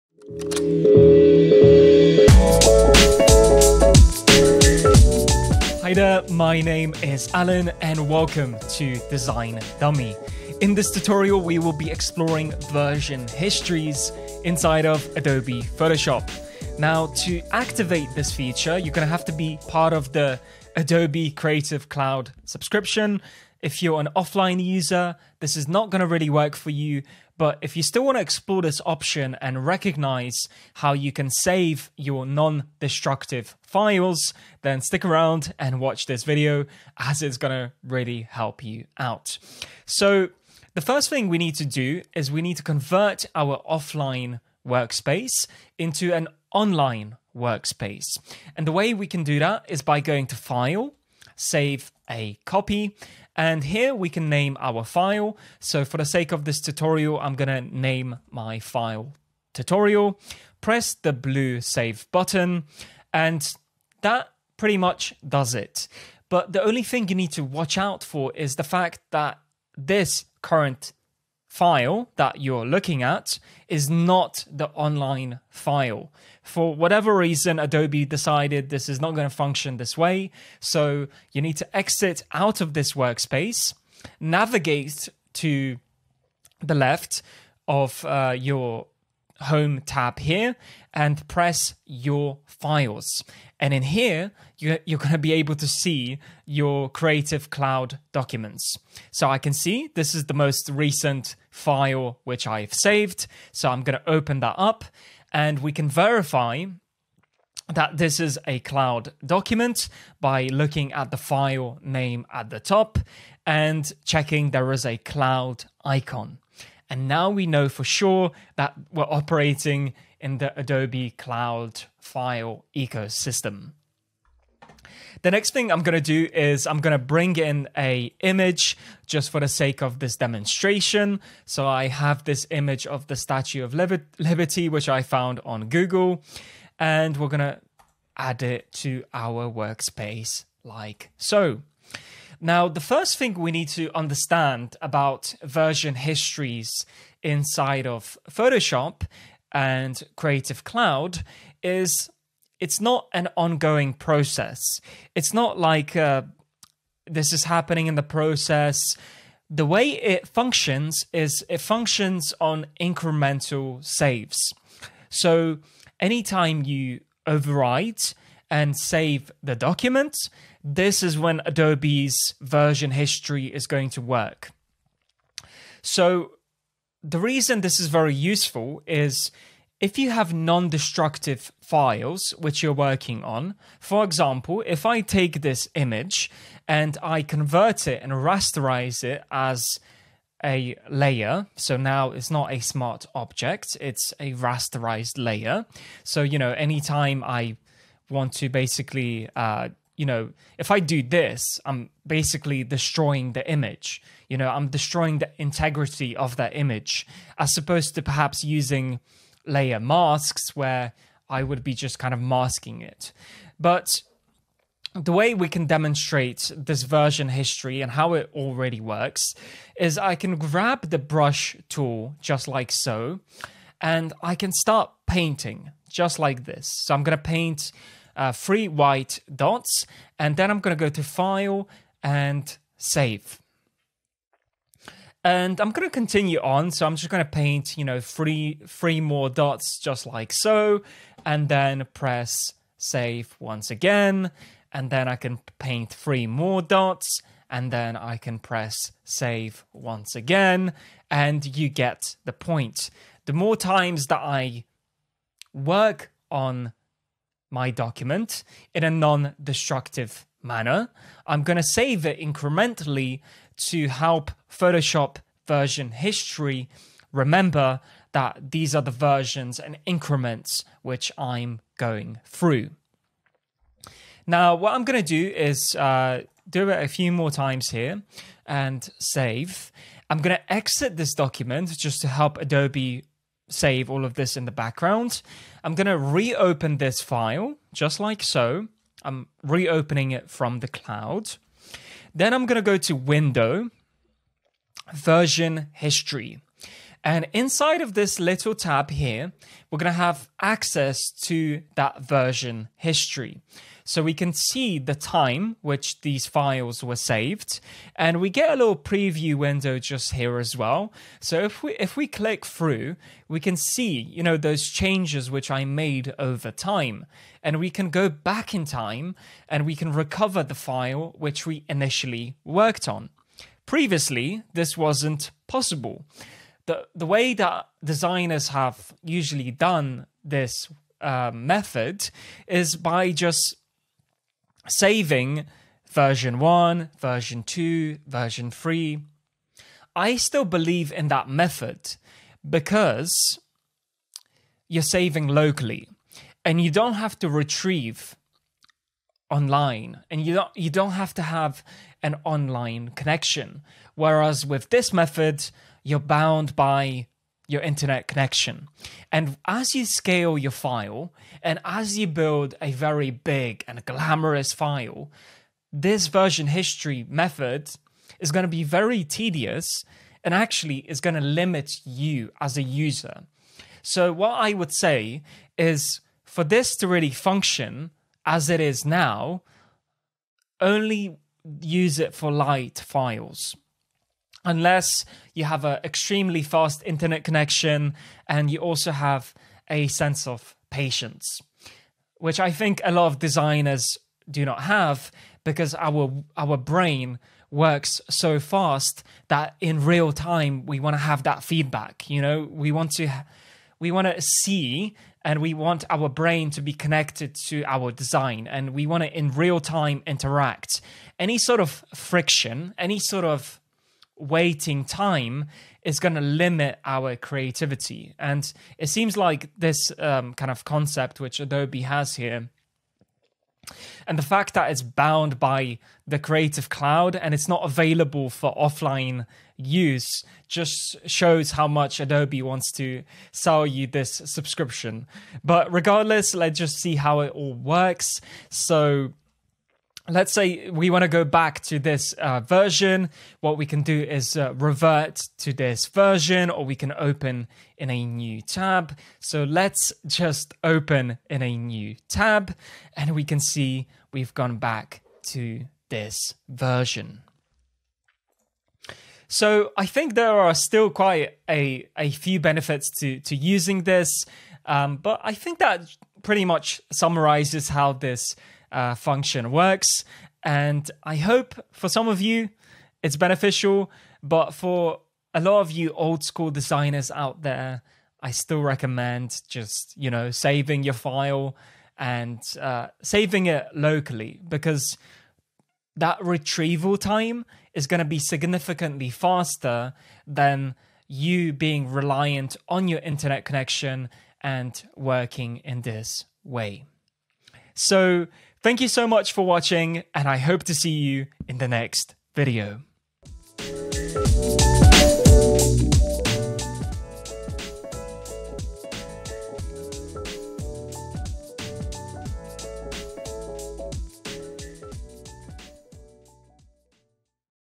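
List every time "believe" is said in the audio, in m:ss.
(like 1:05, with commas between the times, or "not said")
5:40.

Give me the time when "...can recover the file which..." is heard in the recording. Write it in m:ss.
5:19.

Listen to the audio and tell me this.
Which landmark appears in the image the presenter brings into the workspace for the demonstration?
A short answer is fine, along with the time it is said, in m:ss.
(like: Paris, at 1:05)
Statue of Liberty, at 2:13.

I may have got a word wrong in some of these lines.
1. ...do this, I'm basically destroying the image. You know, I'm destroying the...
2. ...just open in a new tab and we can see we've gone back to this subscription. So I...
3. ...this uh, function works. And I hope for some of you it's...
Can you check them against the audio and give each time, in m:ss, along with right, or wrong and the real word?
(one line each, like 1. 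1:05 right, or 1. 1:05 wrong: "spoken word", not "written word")
1. 3:20 right
2. 7:30 wrong: "version", not "subscription"
3. 7:47 right.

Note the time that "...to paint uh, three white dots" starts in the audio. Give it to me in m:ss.
3:47.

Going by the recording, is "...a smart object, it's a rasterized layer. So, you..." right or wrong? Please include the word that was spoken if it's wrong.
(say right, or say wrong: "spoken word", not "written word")
right.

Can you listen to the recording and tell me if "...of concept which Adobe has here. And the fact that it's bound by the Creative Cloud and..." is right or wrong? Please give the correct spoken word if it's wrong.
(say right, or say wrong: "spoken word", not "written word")
right.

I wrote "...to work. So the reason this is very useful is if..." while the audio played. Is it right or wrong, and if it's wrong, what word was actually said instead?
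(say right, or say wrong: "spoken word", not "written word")
right.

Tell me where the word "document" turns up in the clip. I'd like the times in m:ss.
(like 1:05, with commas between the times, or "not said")
1:38, 1:49, 2:49, 4:17, 4:41.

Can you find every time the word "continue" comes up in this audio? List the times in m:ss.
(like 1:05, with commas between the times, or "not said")
3:55.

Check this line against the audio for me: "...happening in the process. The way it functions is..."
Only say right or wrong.
right.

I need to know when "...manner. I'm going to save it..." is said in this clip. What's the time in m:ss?
4:20.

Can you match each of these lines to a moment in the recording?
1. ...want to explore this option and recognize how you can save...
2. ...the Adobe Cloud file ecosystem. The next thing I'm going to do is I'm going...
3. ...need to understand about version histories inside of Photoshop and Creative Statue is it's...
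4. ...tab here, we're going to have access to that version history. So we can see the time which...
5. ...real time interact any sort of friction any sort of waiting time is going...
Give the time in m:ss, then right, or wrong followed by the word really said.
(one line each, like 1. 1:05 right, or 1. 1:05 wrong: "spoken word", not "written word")
1. 0:28 right
2. 2:00 right
3. 2:23 wrong: "Cloud", not "Statue"
4. 4:58 right
5. 6:49 right.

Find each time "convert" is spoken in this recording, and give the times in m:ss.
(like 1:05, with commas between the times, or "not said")
0:42, 3:07.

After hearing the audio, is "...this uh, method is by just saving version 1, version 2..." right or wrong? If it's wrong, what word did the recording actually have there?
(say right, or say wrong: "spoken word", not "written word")
right.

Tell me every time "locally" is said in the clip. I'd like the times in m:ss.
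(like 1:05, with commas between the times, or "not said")
5:45, 8:03.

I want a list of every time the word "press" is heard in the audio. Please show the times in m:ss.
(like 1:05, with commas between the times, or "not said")
1:00, 1:31, 4:01, 4:08.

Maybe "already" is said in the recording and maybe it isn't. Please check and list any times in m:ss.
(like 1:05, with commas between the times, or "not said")
3:38.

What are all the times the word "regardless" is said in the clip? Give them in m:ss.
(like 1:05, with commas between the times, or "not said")
7:15.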